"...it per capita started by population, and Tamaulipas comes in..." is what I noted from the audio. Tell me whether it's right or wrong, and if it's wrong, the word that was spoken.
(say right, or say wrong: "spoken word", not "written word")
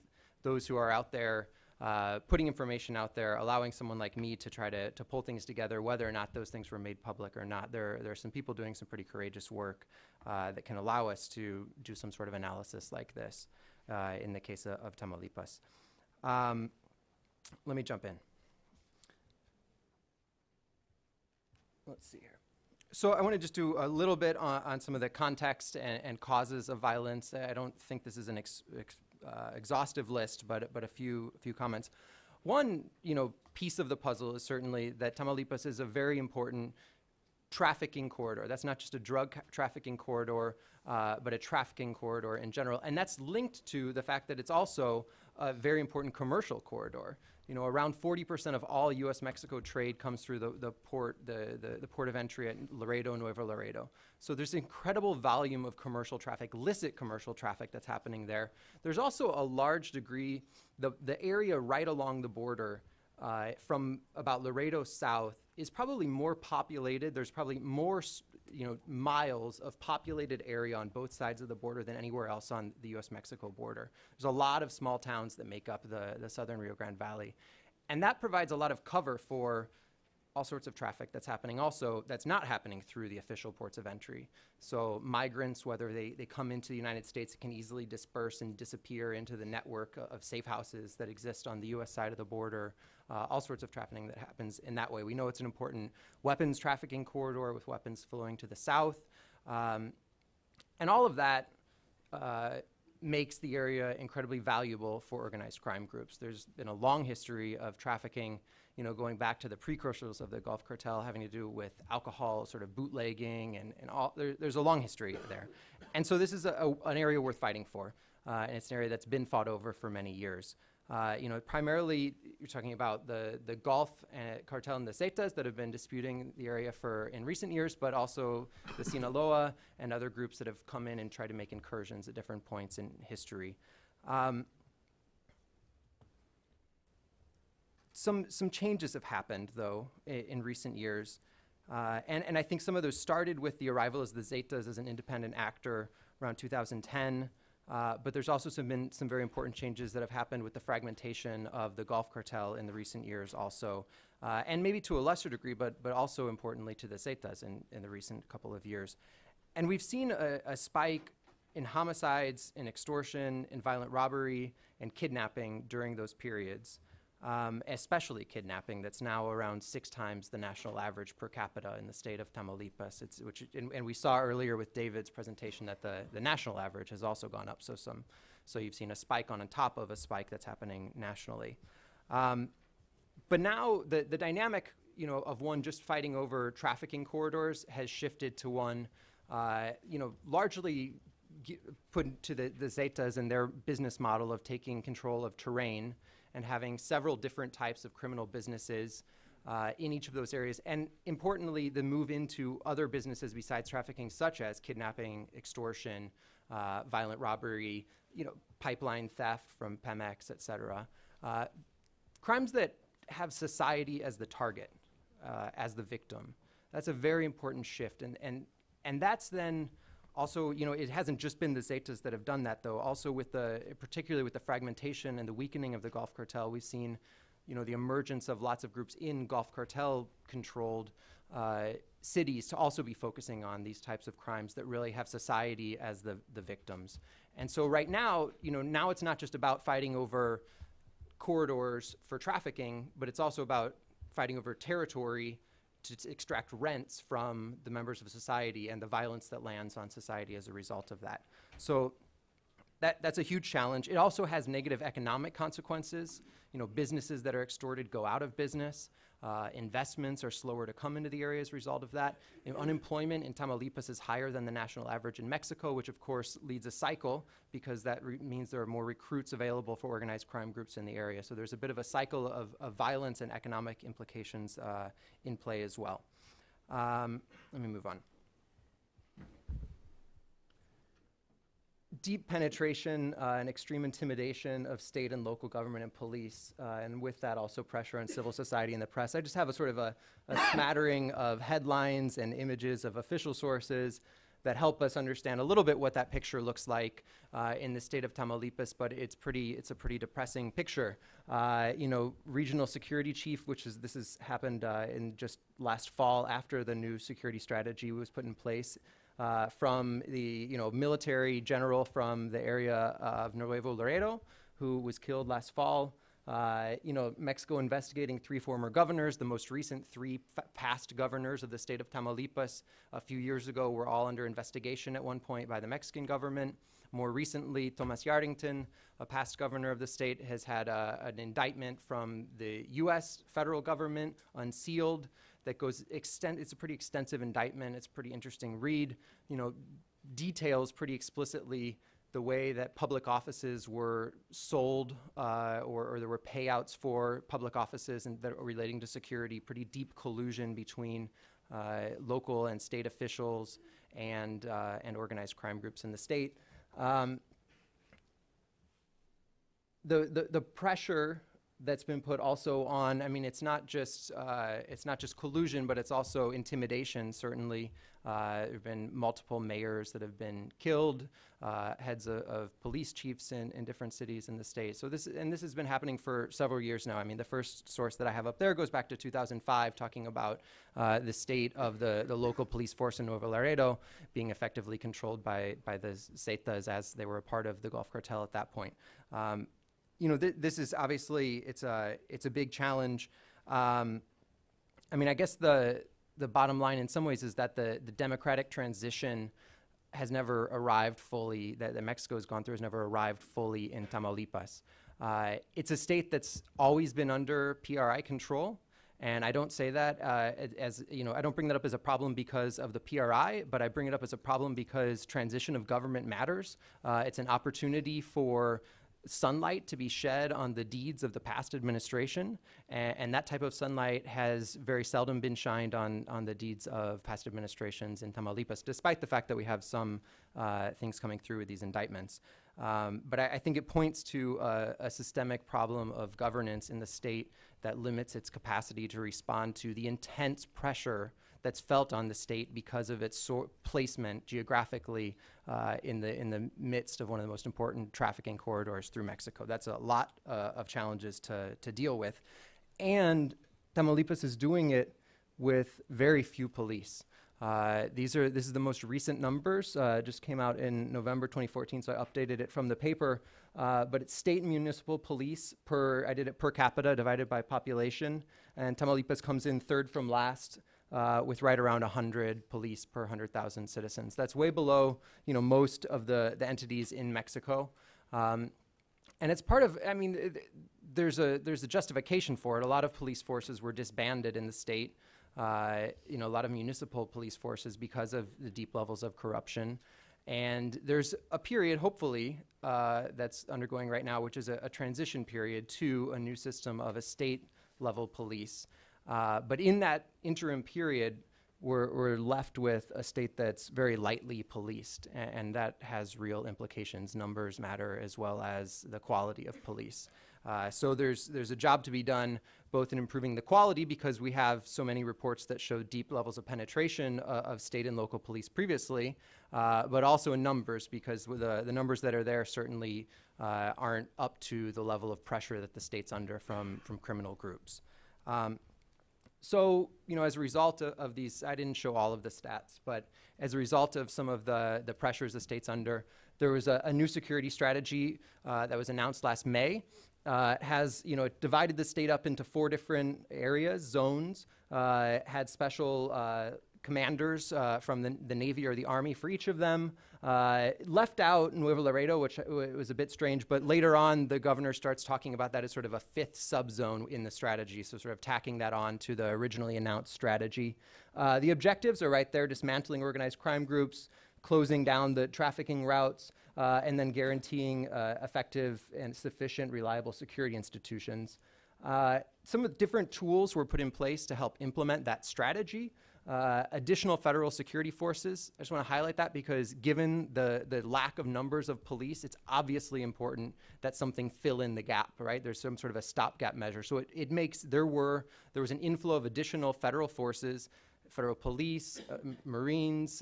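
wrong: "divided", not "started".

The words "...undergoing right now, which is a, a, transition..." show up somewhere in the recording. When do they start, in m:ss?
8:13.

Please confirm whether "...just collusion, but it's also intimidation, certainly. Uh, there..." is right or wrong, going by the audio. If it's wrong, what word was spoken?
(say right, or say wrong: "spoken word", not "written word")
right.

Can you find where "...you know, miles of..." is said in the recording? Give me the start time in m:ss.
1:08.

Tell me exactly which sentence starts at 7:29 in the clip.
That's a lot uh, of challenges to to deal with, and Tamaulipas is doing it with very few police.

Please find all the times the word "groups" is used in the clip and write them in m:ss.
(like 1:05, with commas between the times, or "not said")
1:45, 2:10, 3:48, 4:30, 5:55, 8:47, 9:23.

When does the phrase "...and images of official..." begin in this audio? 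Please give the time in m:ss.
4:52.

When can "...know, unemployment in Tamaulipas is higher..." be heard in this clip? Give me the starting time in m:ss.
4:22.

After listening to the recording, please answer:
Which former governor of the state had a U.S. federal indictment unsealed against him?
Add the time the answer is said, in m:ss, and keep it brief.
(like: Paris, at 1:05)
Thomas Yarrington, at 5:27.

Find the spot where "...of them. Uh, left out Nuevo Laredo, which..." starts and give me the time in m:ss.
9:09.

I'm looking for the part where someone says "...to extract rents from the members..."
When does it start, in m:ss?
4:05.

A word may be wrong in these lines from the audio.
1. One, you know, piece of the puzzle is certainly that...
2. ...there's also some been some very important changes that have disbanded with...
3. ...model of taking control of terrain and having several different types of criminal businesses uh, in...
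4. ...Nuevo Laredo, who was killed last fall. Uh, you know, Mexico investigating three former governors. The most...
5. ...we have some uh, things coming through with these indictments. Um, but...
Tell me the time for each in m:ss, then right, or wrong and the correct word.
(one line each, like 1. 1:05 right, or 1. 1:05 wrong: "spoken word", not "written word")
1. 0:32 right
2. 2:28 wrong: "happened", not "disbanded"
3. 3:14 right
4. 5:13 right
5. 7:09 right.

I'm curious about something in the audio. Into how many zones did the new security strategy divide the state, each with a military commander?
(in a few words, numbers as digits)
4.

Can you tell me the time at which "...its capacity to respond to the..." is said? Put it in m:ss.
7:18.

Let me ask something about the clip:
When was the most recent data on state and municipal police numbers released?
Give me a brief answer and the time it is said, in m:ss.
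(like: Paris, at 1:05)
November 2014, at 7:40.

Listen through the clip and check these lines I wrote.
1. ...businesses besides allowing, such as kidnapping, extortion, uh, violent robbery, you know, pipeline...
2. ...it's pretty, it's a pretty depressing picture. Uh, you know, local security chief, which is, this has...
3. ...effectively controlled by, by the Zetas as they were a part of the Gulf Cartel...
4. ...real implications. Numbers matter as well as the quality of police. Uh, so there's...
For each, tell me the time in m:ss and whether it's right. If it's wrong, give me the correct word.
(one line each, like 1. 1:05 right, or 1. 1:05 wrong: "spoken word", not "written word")
1. 3:22 wrong: "trafficking", not "allowing"
2. 4:58 wrong: "regional", not "local"
3. 6:24 right
4. 8:26 right.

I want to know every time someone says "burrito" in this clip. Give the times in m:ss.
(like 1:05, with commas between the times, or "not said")
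not said.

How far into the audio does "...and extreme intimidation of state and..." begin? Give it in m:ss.
4:43.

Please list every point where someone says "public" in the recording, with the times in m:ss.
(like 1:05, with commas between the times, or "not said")
0:07, 5:42, 5:47.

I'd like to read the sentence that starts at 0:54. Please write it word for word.
So there's incredible volume of commercial traffic, illicit commercial traffic that's happening there.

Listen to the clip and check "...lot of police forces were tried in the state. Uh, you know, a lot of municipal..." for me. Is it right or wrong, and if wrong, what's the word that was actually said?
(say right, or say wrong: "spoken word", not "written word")
wrong: "disbanded", not "tried".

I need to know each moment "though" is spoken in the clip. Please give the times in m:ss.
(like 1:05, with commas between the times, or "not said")
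2:19, 3:42.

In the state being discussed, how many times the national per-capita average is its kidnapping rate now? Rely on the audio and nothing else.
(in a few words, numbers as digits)
6 times.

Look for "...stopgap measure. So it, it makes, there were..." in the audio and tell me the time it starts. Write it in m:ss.
9:46.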